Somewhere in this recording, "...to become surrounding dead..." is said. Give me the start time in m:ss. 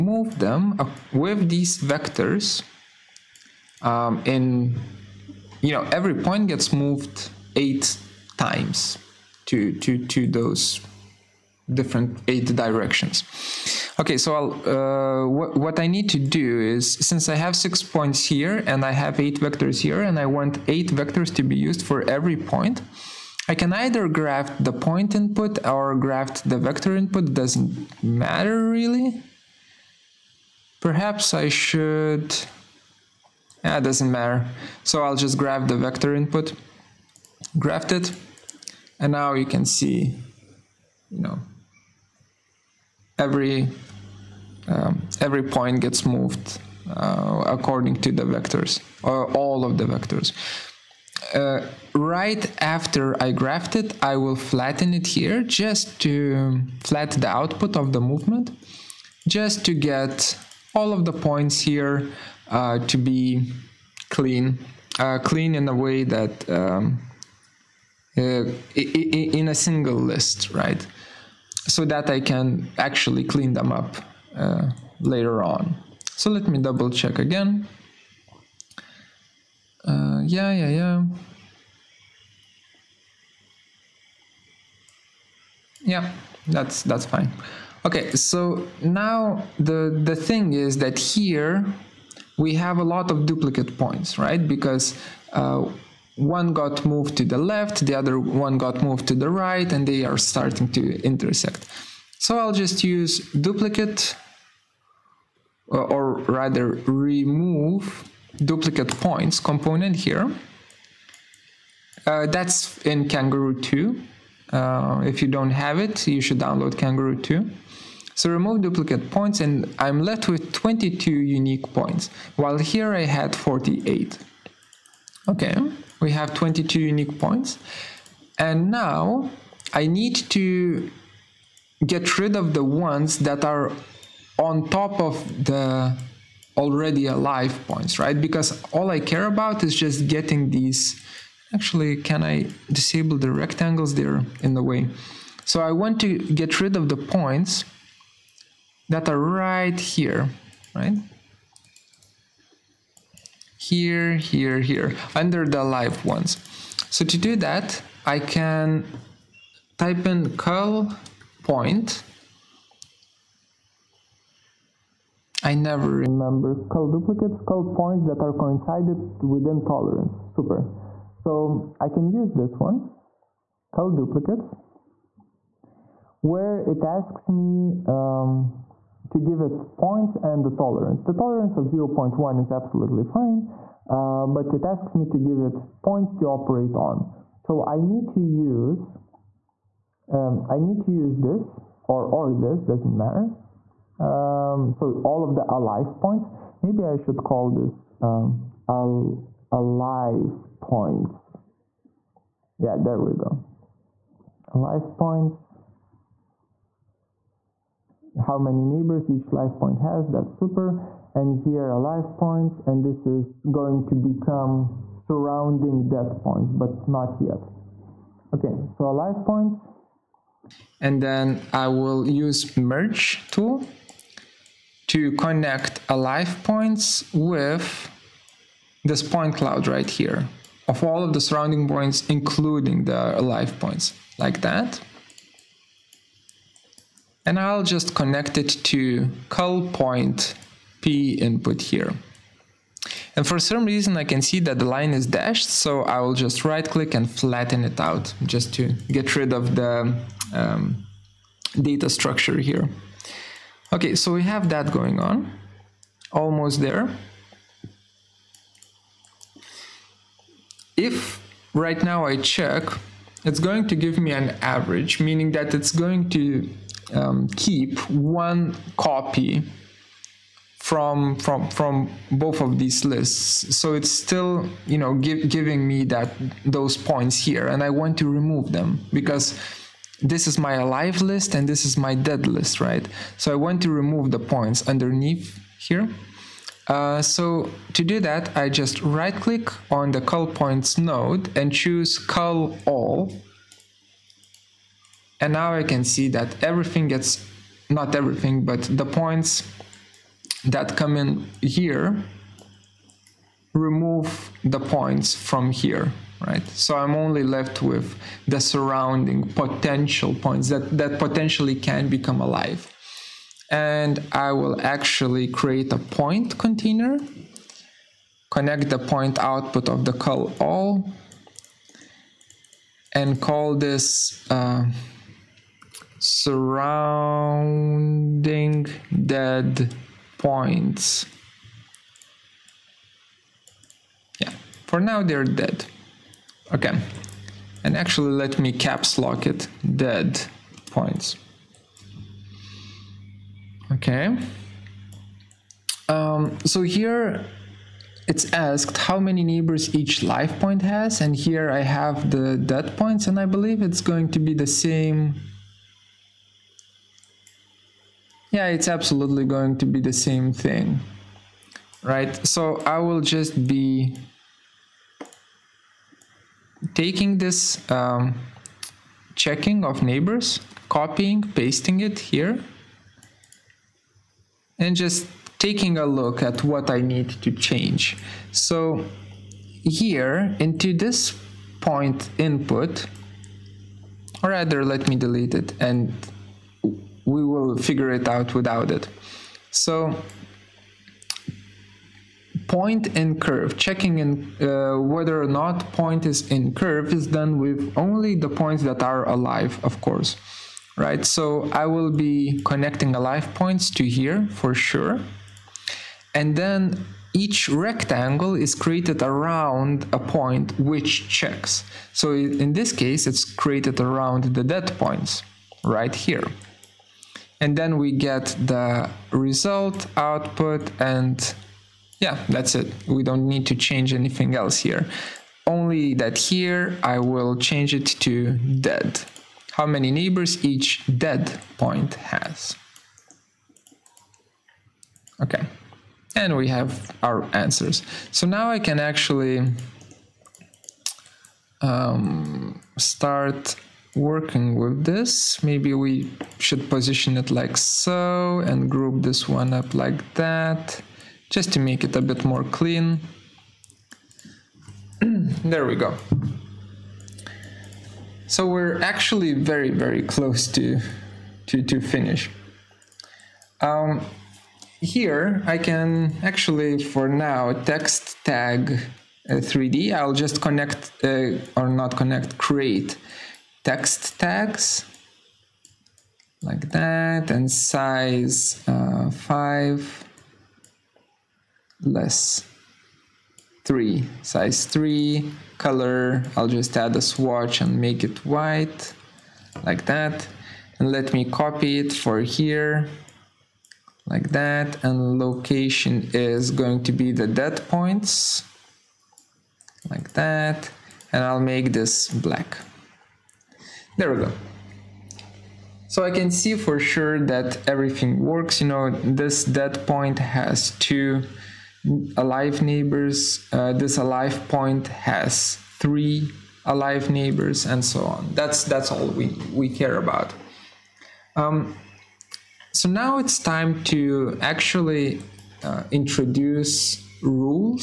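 3:33.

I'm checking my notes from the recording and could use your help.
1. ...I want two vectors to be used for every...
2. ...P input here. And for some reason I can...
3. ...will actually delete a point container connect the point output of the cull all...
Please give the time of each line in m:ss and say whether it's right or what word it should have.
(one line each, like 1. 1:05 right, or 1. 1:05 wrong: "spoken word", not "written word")
1. 0:20 wrong: "eight", not "two"
2. 4:00 right
3. 5:14 wrong: "create", not "delete".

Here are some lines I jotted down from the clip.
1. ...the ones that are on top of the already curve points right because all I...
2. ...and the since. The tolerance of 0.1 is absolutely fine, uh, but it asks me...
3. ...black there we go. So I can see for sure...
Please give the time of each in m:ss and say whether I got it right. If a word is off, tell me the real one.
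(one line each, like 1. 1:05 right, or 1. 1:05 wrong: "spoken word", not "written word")
1. 2:12 wrong: "alive", not "curve"
2. 3:00 wrong: "tolerance", not "since"
3. 8:22 right.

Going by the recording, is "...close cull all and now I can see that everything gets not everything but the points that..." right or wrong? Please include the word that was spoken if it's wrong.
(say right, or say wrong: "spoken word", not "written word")
wrong: "choose", not "close".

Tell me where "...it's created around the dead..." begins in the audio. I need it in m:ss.
6:53.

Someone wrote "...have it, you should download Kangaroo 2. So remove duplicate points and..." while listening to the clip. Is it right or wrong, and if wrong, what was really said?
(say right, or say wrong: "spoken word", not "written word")
right.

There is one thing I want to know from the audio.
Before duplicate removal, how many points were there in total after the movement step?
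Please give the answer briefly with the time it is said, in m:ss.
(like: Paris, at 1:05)
48, at 2:03.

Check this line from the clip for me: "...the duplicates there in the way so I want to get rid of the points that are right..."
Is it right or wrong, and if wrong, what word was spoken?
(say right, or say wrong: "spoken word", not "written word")
wrong: "rectangles", not "duplicates".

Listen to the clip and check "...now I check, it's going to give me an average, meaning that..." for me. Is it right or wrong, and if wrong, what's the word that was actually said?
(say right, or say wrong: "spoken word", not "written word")
right.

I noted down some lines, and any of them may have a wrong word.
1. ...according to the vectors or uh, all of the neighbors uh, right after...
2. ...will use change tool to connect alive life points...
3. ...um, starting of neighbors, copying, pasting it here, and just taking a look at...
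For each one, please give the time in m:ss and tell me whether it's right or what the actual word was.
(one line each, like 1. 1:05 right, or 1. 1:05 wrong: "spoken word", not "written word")
1. 0:47 wrong: "vectors", not "neighbors"
2. 3:41 wrong: "merge", not "change"
3. 6:07 wrong: "checking", not "starting".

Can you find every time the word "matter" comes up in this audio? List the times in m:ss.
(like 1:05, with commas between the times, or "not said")
0:28, 0:34, 3:12.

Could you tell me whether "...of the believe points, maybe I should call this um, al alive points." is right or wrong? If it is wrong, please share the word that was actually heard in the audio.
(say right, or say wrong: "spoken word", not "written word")
wrong: "alive", not "believe".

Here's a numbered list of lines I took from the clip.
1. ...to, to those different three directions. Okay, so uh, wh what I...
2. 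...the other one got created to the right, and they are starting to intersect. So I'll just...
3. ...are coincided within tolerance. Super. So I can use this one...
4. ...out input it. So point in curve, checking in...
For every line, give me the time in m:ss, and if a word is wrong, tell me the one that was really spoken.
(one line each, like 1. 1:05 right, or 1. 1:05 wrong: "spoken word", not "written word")
1. 0:09 wrong: "eight", not "three"
2. 1:37 wrong: "moved", not "created"
3. 2:48 right
4. 6:28 wrong: "without", not "input".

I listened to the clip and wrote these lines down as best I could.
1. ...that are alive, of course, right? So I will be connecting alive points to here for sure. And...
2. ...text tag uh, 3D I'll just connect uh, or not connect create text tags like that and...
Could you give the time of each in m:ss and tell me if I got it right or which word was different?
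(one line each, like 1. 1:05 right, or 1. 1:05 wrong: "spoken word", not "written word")
1. 6:38 right
2. 7:47 right.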